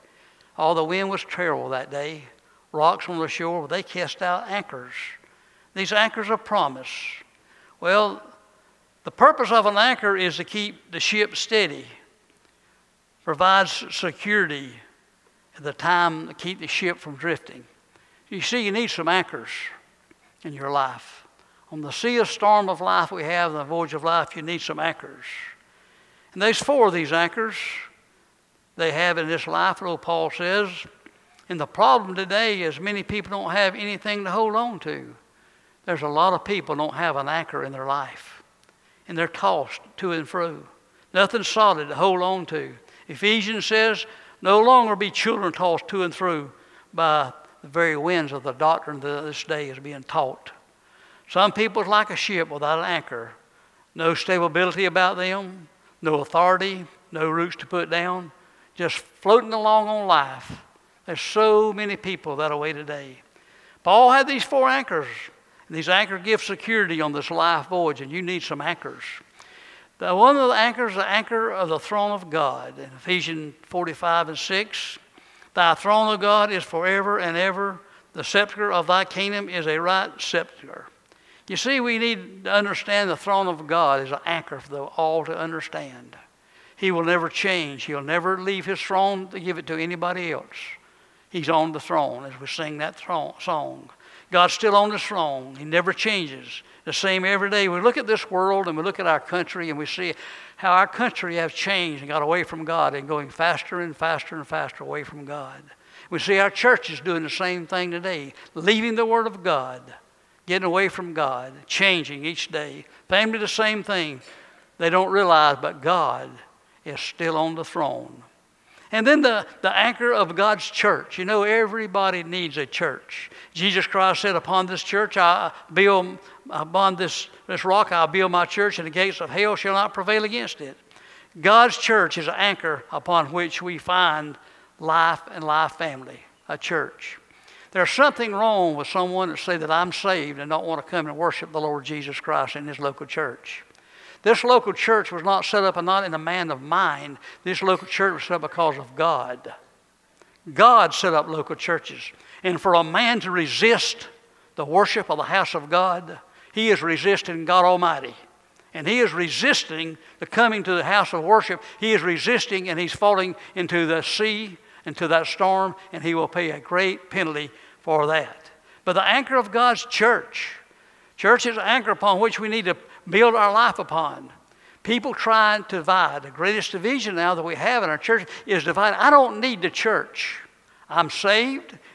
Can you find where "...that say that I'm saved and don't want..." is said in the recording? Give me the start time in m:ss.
2:19.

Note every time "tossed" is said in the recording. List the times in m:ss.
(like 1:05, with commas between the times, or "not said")
0:39, 0:45.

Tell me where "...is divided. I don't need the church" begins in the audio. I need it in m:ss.
2:58.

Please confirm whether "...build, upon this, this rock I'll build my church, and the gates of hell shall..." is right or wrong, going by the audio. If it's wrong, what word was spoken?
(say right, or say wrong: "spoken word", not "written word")
right.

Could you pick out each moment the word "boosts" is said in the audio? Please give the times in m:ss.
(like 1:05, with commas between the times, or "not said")
not said.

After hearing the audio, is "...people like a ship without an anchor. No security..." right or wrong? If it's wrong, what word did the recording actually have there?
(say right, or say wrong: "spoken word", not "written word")
wrong: "stability", not "security".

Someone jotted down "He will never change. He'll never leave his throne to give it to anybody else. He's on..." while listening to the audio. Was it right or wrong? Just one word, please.
right.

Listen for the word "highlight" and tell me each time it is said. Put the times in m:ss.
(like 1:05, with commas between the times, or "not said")
not said.